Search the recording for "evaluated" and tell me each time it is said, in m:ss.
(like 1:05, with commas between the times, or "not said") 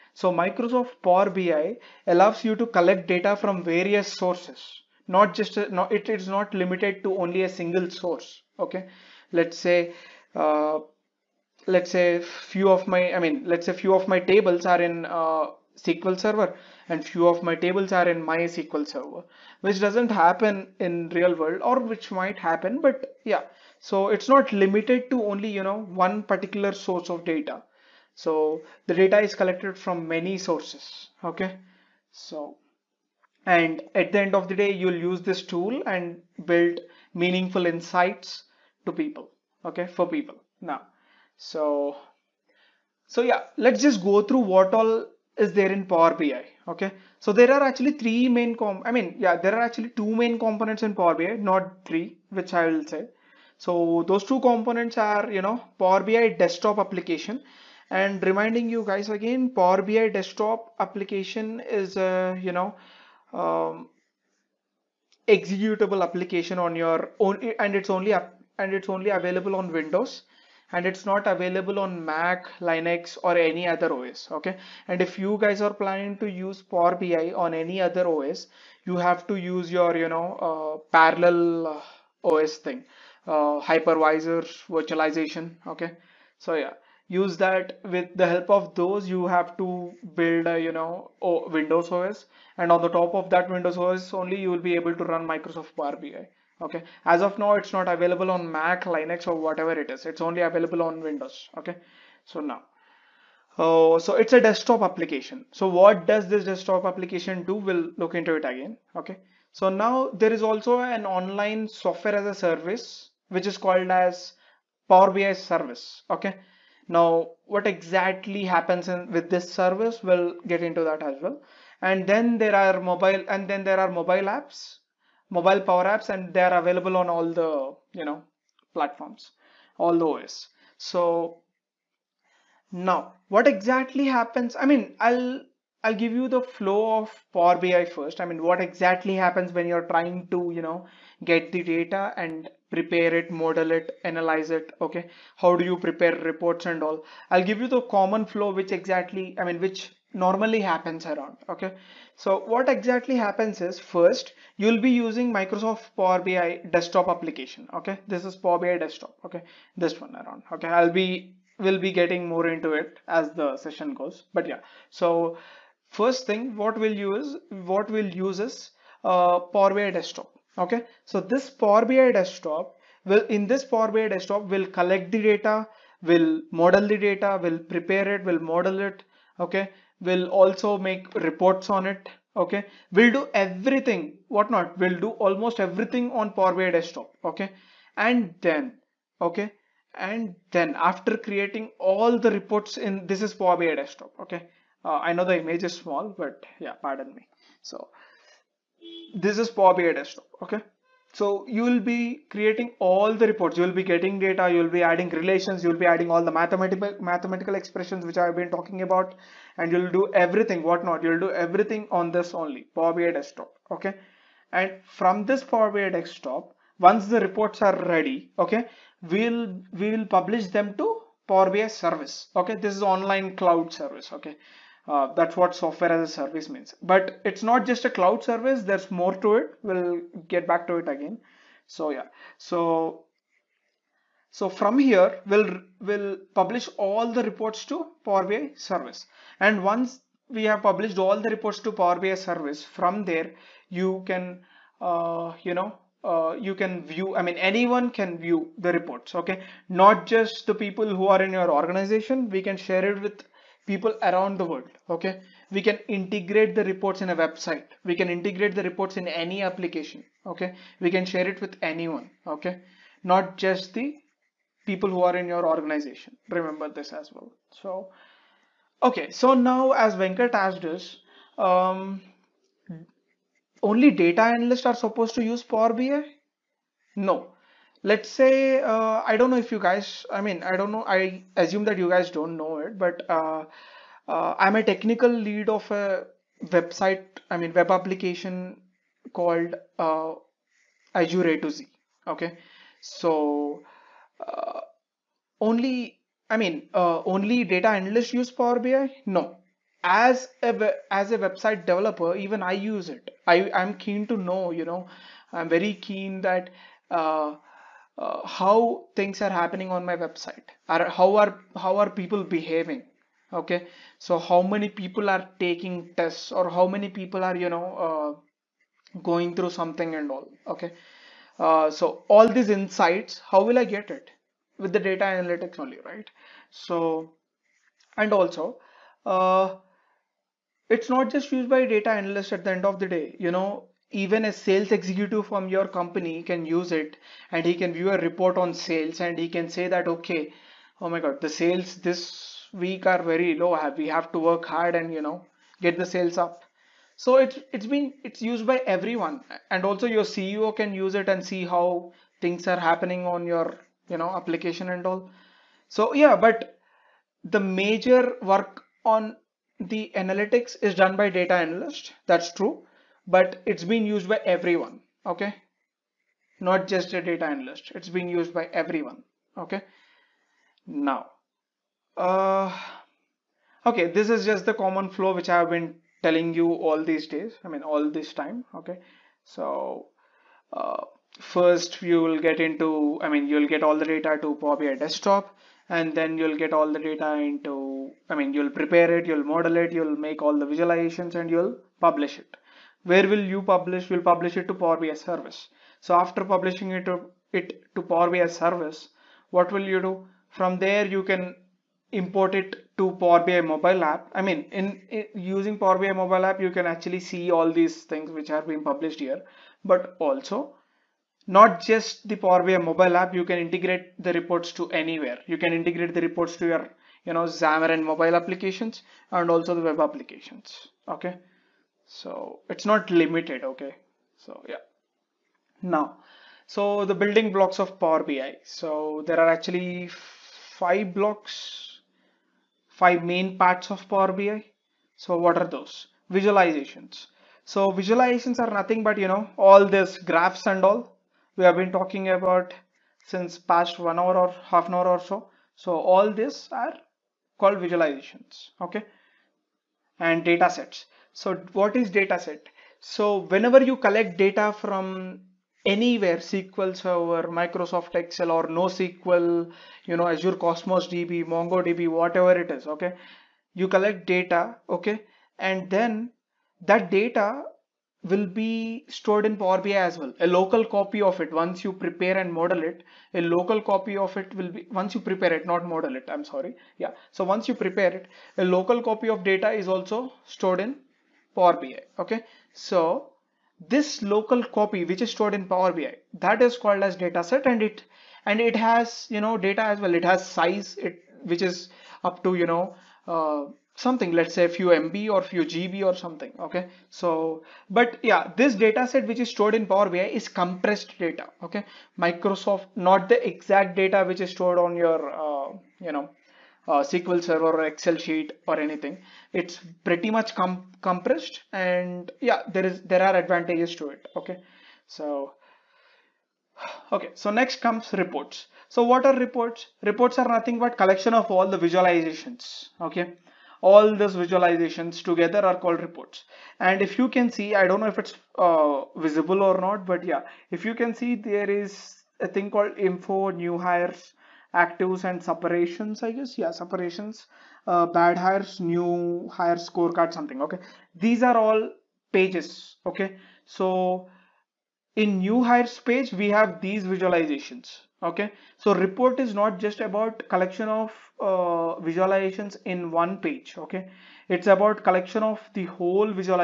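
not said.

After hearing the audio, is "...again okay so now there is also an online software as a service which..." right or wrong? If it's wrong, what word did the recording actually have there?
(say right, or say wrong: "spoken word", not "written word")
right.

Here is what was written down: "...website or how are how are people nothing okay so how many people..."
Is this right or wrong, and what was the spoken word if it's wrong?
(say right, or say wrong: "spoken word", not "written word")
wrong: "behaving", not "nothing".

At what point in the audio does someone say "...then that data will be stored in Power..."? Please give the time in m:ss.
7:45.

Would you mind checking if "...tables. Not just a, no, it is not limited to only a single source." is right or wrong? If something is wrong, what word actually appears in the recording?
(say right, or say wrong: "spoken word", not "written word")
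wrong: "sources", not "tables".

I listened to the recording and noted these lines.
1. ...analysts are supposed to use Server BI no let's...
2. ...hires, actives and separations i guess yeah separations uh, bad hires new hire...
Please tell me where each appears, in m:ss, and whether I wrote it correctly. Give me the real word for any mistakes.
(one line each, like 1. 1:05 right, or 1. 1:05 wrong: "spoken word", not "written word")
1. 4:34 wrong: "Power", not "Server"
2. 8:53 right.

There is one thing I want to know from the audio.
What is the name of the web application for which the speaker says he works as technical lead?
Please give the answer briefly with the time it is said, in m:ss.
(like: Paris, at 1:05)
Azure A to Z, at 4:50.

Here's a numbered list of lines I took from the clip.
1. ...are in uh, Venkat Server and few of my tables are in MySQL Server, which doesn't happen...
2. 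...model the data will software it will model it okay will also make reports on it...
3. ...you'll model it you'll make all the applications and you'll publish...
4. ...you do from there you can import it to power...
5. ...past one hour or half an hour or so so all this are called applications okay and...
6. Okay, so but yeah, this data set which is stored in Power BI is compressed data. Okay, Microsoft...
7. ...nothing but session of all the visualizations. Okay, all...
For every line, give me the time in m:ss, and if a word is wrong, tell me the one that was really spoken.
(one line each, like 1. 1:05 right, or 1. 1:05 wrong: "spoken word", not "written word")
1. 0:14 wrong: "SQL", not "Venkat"
2. 2:56 wrong: "prepare", not "software"
3. 6:29 wrong: "visualizations", not "applications"
4. 6:39 right
5. 7:23 wrong: "visualizations", not "applications"
6. 8:16 right
7. 8:40 wrong: "collection", not "session".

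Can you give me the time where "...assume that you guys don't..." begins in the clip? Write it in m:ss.
4:41.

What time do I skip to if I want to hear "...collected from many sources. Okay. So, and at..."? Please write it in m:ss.
0:29.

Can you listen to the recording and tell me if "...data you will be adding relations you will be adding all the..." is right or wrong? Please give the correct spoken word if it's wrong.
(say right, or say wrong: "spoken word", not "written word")
right.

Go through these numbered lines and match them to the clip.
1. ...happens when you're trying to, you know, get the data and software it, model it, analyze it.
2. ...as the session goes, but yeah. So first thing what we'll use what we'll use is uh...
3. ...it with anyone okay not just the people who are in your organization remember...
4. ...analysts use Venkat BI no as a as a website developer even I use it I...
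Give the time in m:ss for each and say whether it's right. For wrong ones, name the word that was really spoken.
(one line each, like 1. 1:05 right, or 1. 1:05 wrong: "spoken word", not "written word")
1. 2:19 wrong: "prepare", not "software"
2. 2:43 right
3. 4:21 right
4. 4:57 wrong: "Power", not "Venkat".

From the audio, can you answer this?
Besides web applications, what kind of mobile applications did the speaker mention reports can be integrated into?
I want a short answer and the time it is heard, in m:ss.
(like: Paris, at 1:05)
Xamarin, at 6:57.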